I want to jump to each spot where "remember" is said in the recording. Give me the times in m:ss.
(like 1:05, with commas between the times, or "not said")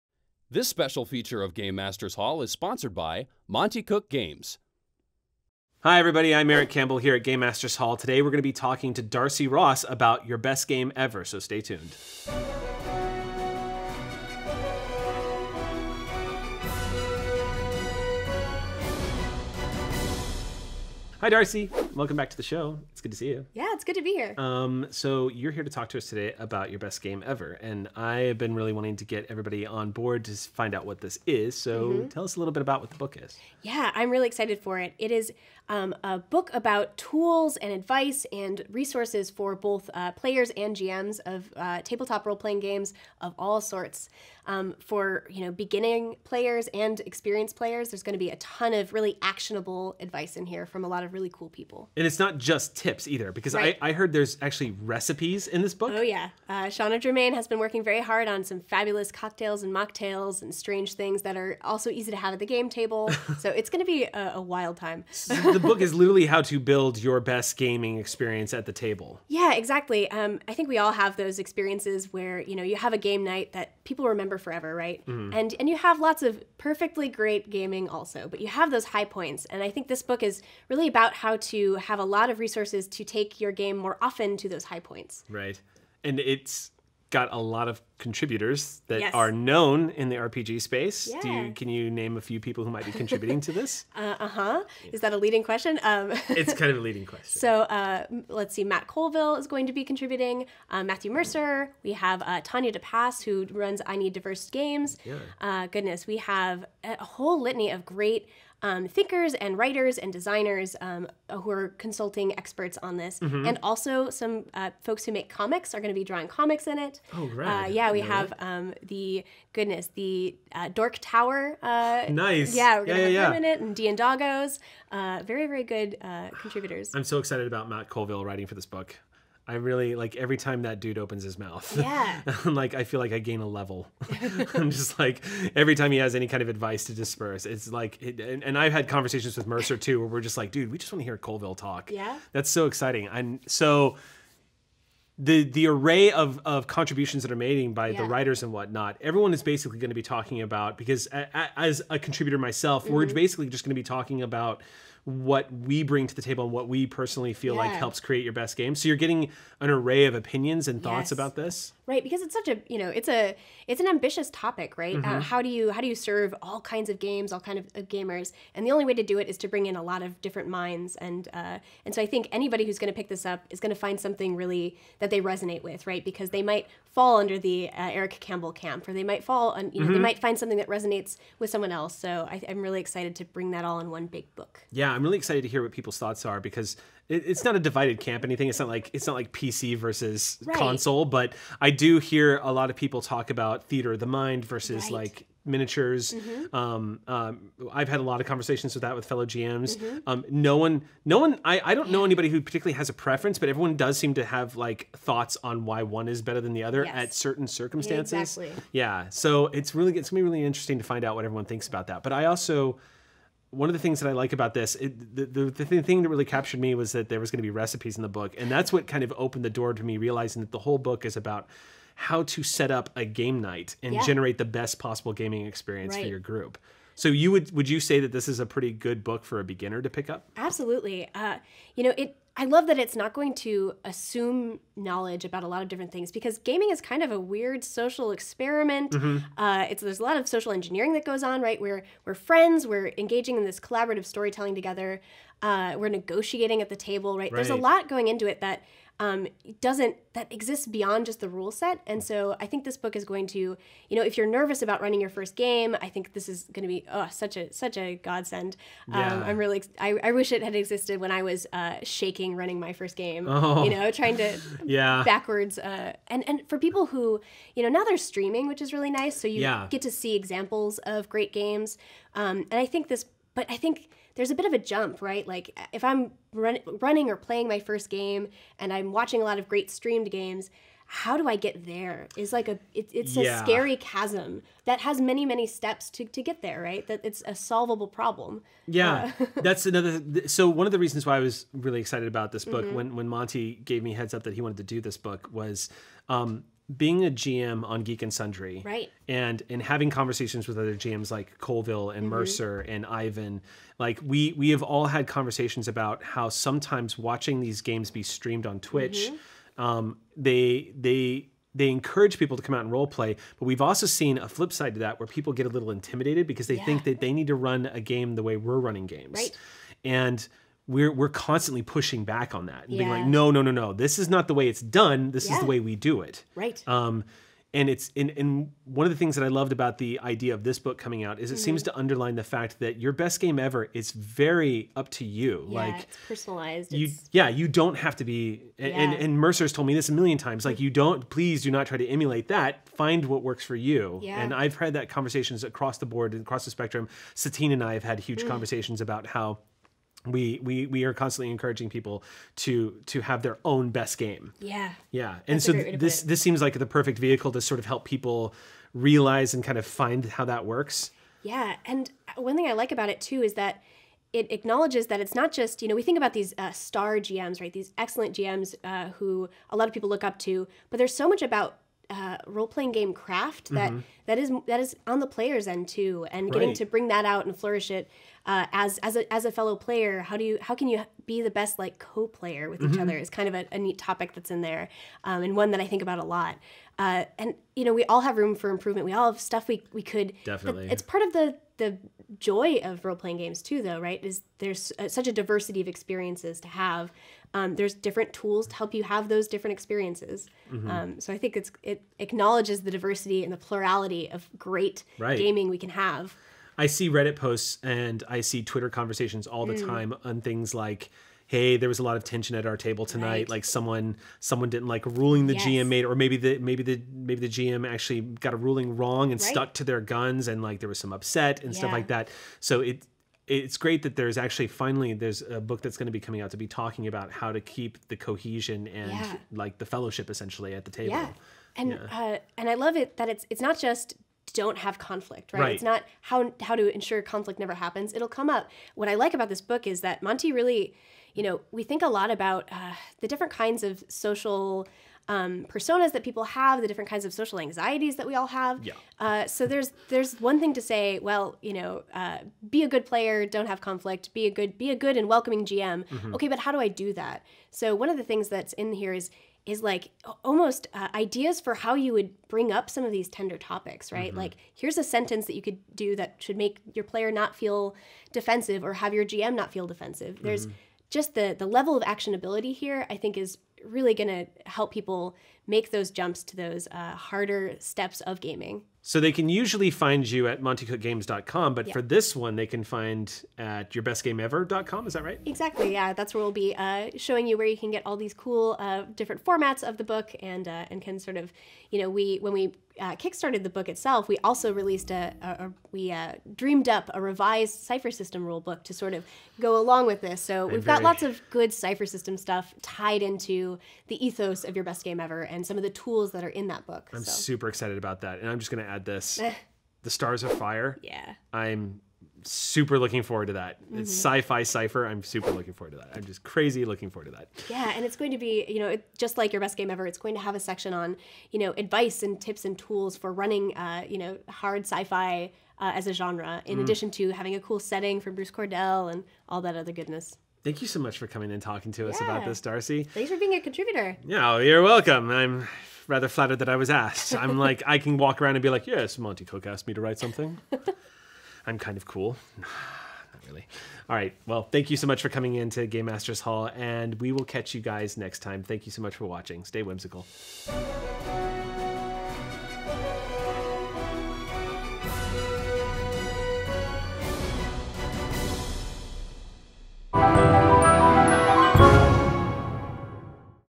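1:14.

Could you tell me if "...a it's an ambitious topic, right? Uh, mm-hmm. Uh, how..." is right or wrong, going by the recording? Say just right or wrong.
right.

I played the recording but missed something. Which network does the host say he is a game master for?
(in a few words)
Geek and Sundry.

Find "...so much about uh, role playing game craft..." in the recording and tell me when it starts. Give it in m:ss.
6:10.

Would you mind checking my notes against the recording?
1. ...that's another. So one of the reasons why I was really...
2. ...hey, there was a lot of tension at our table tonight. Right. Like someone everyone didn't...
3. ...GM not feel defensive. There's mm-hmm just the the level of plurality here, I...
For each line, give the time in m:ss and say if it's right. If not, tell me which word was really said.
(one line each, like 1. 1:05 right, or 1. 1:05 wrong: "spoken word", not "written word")
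1. 4:49 right
2. 6:51 wrong: "someone", not "everyone"
3. 7:49 wrong: "actionability", not "plurality".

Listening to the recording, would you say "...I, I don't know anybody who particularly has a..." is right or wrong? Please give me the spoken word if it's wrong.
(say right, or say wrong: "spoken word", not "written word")
right.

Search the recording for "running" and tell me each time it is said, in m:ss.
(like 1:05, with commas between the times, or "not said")
4:14, 4:22, 4:36, 5:18, 8:43.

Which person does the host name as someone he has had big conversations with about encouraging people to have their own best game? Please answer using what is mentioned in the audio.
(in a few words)
Satine.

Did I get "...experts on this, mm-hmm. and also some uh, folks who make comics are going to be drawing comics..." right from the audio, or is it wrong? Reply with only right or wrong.
right.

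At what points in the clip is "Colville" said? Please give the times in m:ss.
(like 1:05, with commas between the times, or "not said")
1:38, 2:07, 2:21, 5:01.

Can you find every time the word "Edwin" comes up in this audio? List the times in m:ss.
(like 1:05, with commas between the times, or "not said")
not said.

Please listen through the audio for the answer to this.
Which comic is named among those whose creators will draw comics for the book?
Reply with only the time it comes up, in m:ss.
2:00.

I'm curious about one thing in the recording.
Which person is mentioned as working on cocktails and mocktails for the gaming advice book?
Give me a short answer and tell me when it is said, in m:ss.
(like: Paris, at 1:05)
Shanna Germain, at 0:56.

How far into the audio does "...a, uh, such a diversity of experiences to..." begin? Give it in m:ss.
6:34.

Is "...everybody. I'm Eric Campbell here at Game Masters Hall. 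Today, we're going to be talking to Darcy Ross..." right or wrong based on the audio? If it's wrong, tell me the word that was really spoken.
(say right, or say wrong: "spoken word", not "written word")
right.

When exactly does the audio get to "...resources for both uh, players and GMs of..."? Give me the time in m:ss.
0:38.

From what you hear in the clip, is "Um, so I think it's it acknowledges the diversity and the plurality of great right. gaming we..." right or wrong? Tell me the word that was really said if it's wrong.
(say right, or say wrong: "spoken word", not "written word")
right.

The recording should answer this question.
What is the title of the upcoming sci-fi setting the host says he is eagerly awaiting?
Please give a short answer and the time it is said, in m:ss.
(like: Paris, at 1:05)
The Stars Are Fire, at 8:29.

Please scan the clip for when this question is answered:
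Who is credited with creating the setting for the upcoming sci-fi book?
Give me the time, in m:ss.
8:48.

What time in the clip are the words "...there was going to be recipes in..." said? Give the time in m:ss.
3:37.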